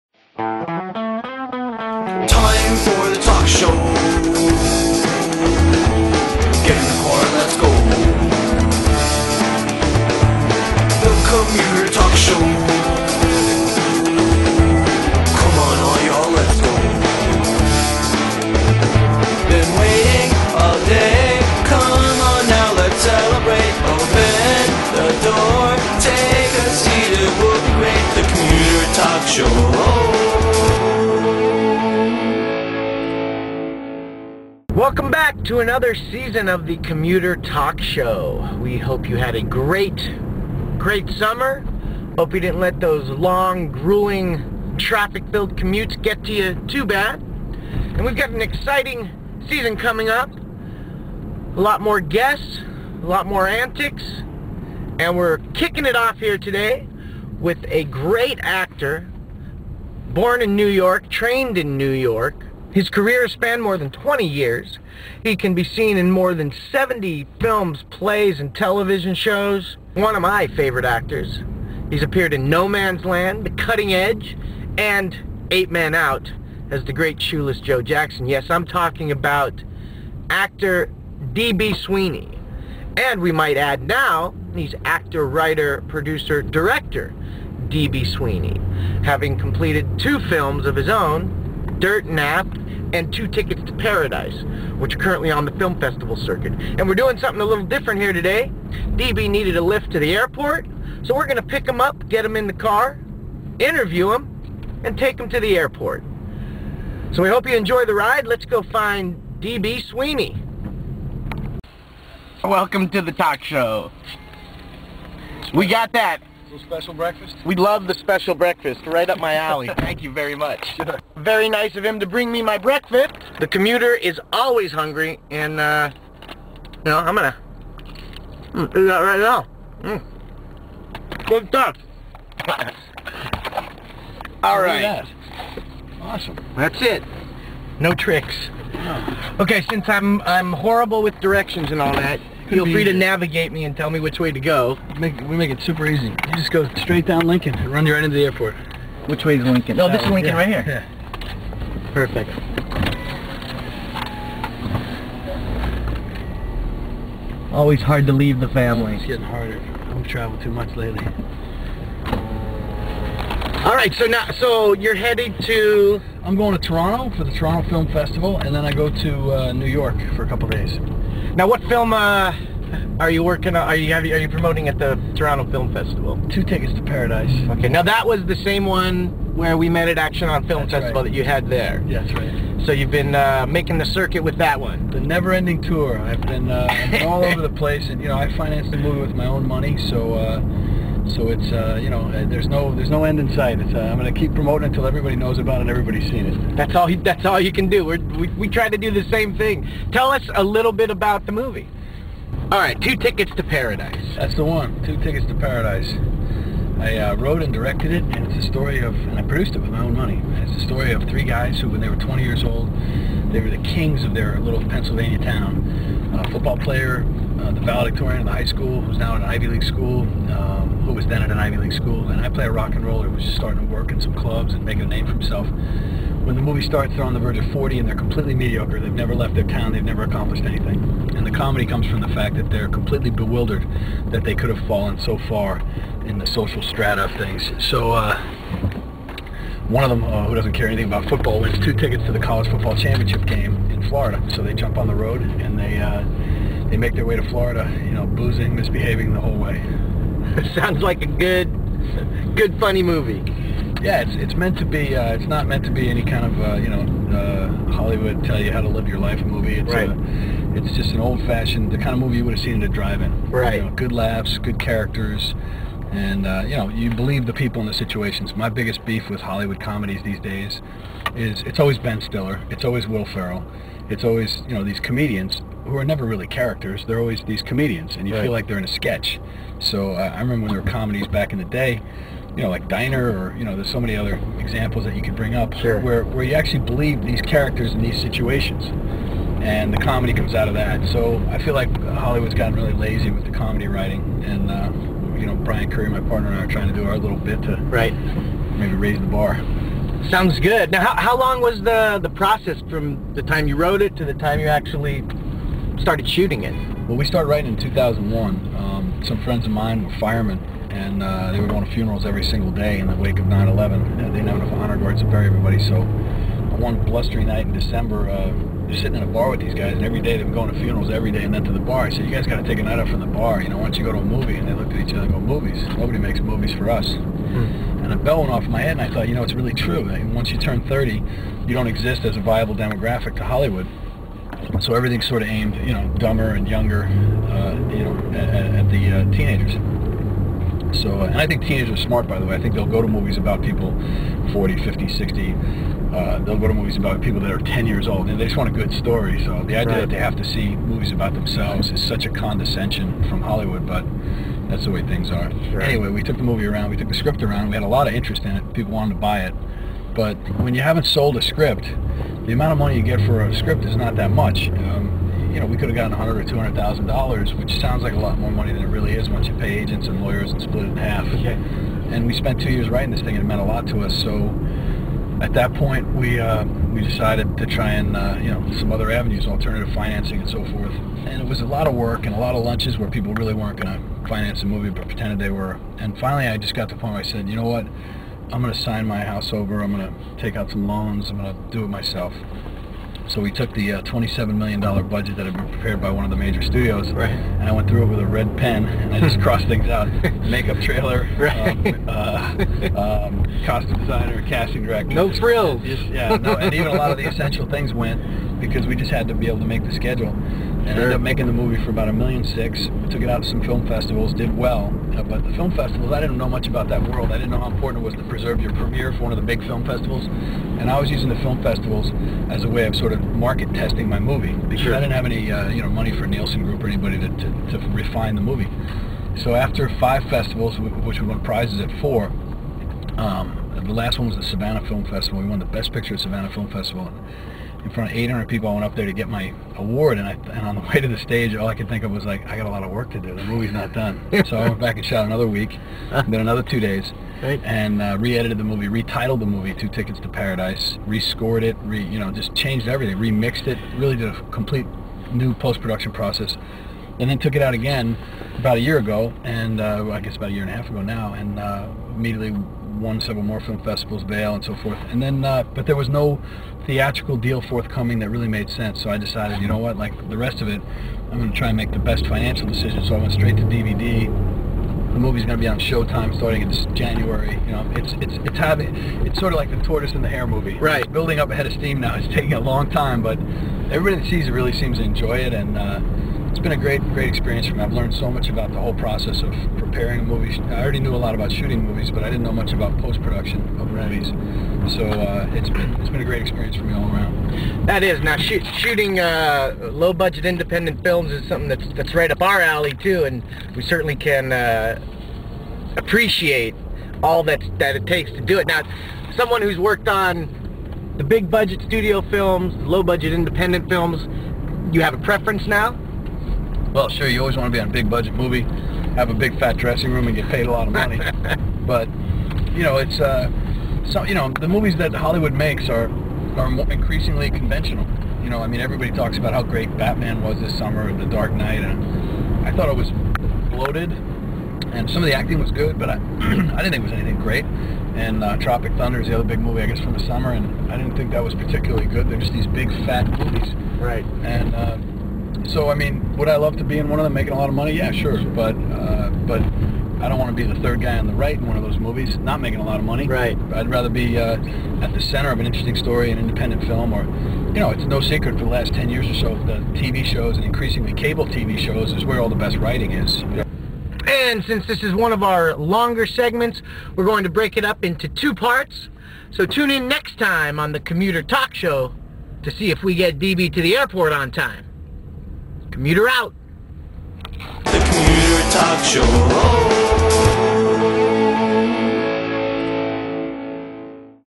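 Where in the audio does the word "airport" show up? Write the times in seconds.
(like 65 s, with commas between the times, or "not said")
100 s, 105 s, 148 s, 573 s.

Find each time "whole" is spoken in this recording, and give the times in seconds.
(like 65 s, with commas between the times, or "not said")
249 s, 488 s.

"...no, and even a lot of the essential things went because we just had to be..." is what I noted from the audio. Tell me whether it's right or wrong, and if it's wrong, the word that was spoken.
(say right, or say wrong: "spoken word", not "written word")
right.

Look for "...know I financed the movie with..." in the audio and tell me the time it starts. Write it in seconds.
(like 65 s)
188 s.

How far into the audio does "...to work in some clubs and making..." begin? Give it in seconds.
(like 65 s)
223 s.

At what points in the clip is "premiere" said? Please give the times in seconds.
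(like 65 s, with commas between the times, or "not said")
418 s.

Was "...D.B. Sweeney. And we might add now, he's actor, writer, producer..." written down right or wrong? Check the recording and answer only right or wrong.
right.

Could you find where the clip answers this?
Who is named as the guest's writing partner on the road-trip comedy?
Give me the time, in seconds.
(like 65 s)
295 s.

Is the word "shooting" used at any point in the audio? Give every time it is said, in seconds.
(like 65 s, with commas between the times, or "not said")
306 s, 491 s, 498 s.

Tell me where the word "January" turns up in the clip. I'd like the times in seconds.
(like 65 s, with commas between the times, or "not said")
476 s.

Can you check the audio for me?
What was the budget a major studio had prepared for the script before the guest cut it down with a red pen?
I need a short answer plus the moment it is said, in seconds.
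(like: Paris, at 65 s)
$27 million, at 393 s.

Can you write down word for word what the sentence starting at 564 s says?
And since this is one of our longer segments, we're going to break it up into two parts.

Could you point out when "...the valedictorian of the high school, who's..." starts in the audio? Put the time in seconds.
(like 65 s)
217 s.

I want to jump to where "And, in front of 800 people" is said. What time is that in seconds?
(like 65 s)
436 s.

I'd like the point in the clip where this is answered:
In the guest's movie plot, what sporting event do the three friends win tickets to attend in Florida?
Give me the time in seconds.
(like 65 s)
242 s.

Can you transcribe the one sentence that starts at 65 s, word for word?
He can be seen in more than 70 films, plays, and television shows.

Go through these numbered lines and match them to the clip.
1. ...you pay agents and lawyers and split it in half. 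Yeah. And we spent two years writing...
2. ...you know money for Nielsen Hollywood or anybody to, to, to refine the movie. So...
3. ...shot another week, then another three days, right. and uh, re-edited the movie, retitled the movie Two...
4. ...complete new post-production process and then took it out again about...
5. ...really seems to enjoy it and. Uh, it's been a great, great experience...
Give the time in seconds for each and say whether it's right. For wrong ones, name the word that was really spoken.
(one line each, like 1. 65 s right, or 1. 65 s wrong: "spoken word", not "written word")
1. 369 s right
2. 425 s wrong: "Group", not "Hollywood"
3. 444 s wrong: "two", not "three"
4. 454 s right
5. 484 s right.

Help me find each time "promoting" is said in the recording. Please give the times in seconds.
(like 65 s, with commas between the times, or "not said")
174 s, 194 s.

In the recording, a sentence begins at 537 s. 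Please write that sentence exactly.
And uh, Tropic Thunder is the other big movie, I guess, from the summer, and I didn't think that was particularly good.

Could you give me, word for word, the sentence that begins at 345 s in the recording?
Uh, they'll go to movies about people that are 10 years old, and they just want a good story.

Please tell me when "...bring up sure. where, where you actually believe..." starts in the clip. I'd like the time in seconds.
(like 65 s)
285 s.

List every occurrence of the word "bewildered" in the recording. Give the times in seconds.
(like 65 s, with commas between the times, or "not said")
233 s.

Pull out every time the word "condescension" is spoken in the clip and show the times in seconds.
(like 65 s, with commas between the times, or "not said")
352 s.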